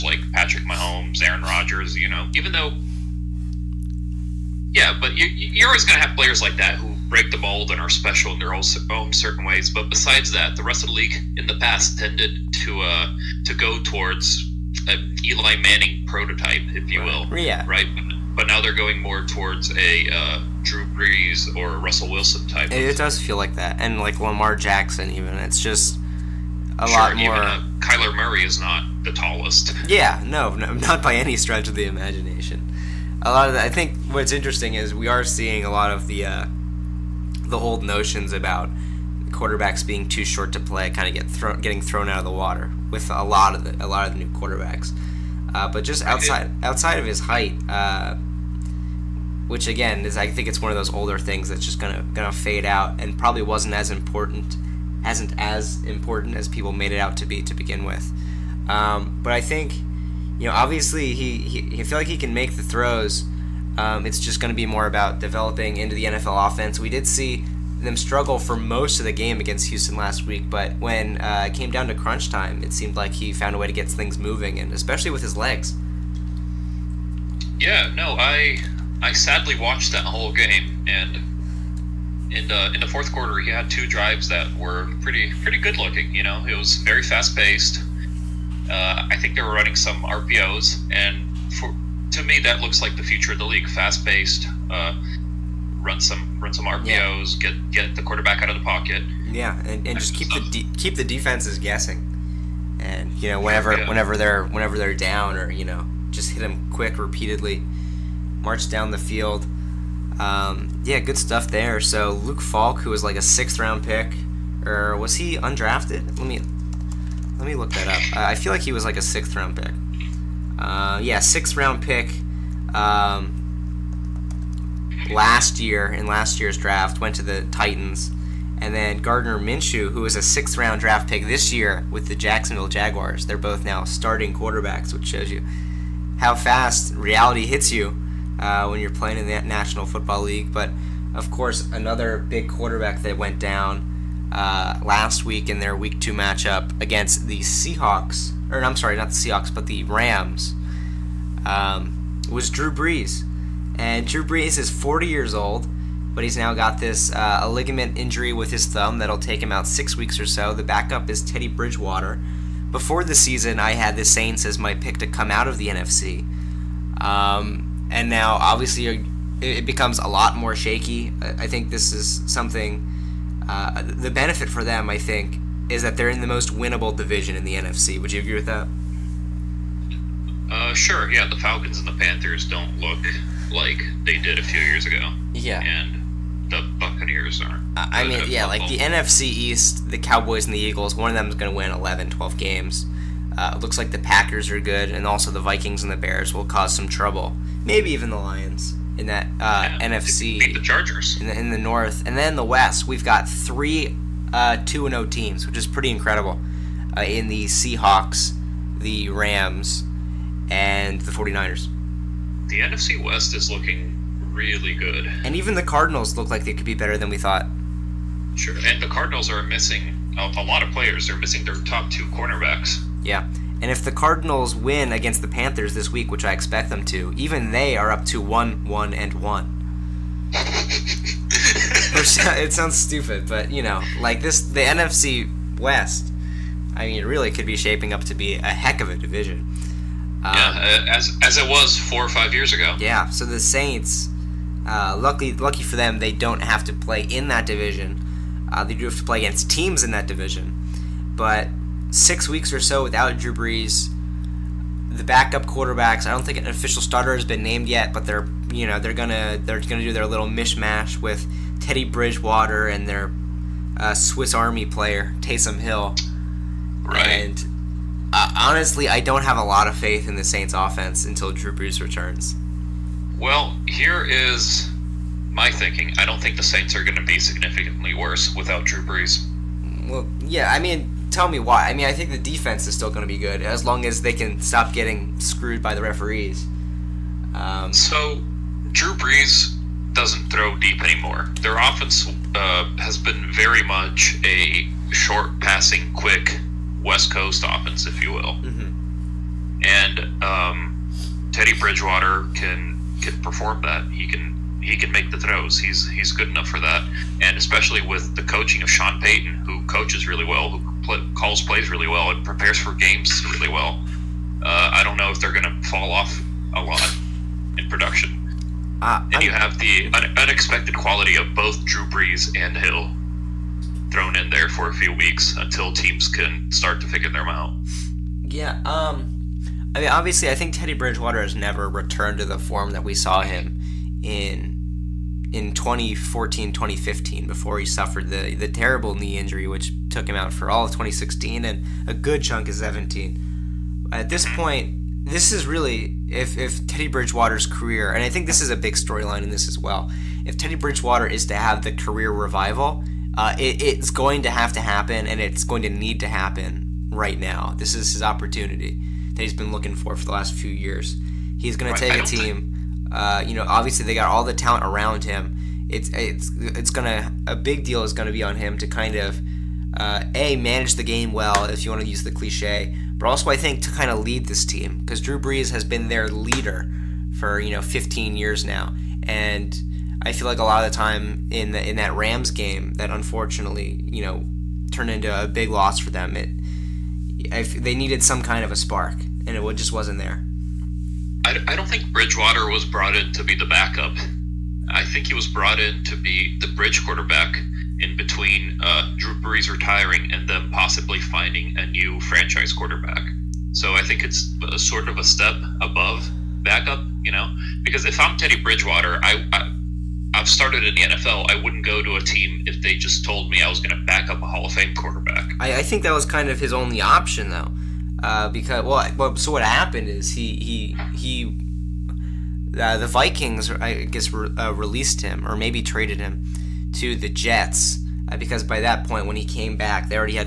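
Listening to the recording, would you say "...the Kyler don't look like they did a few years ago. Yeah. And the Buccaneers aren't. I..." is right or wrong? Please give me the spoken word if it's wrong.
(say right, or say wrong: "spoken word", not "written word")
wrong: "Panthers", not "Kyler".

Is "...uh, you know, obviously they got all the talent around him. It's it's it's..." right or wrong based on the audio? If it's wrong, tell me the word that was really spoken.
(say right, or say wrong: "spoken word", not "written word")
right.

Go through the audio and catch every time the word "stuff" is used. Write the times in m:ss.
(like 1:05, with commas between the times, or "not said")
1:40, 1:51.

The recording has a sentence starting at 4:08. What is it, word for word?
Uh, they do have to play against teams in that division.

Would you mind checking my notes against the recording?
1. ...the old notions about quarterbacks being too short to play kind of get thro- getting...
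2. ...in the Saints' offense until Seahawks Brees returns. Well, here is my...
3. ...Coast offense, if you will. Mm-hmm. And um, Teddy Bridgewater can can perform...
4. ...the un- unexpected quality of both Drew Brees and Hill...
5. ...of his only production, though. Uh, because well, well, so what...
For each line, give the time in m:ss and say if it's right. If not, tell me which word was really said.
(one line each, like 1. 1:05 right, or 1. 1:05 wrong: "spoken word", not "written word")
1. 0:37 right
2. 4:30 wrong: "Drew", not "Seahawks"
3. 4:57 right
4. 5:19 right
5. 6:56 wrong: "option", not "production".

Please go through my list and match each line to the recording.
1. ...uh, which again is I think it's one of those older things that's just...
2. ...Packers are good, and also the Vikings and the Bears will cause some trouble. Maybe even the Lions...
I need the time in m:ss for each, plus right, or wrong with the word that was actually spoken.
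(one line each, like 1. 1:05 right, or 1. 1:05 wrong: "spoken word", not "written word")
1. 0:47 right
2. 3:13 right.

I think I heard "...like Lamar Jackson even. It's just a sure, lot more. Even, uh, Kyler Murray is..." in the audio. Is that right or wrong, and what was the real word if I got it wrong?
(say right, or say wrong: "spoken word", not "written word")
right.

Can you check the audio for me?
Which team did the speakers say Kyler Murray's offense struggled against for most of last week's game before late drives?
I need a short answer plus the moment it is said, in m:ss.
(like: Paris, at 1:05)
Houston, at 1:09.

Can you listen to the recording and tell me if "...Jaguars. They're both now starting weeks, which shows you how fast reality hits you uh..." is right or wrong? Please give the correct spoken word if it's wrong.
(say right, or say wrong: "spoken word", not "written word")
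wrong: "quarterbacks", not "weeks".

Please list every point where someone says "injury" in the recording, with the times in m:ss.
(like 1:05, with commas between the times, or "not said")
2:37, 5:39.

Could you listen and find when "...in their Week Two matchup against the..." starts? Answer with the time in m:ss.
2:25.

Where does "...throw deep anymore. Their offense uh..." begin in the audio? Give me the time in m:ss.
4:50.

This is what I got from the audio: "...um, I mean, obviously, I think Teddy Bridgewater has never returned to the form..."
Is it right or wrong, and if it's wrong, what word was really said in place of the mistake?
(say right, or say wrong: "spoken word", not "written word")
right.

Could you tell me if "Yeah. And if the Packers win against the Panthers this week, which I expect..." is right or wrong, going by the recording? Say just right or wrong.
wrong.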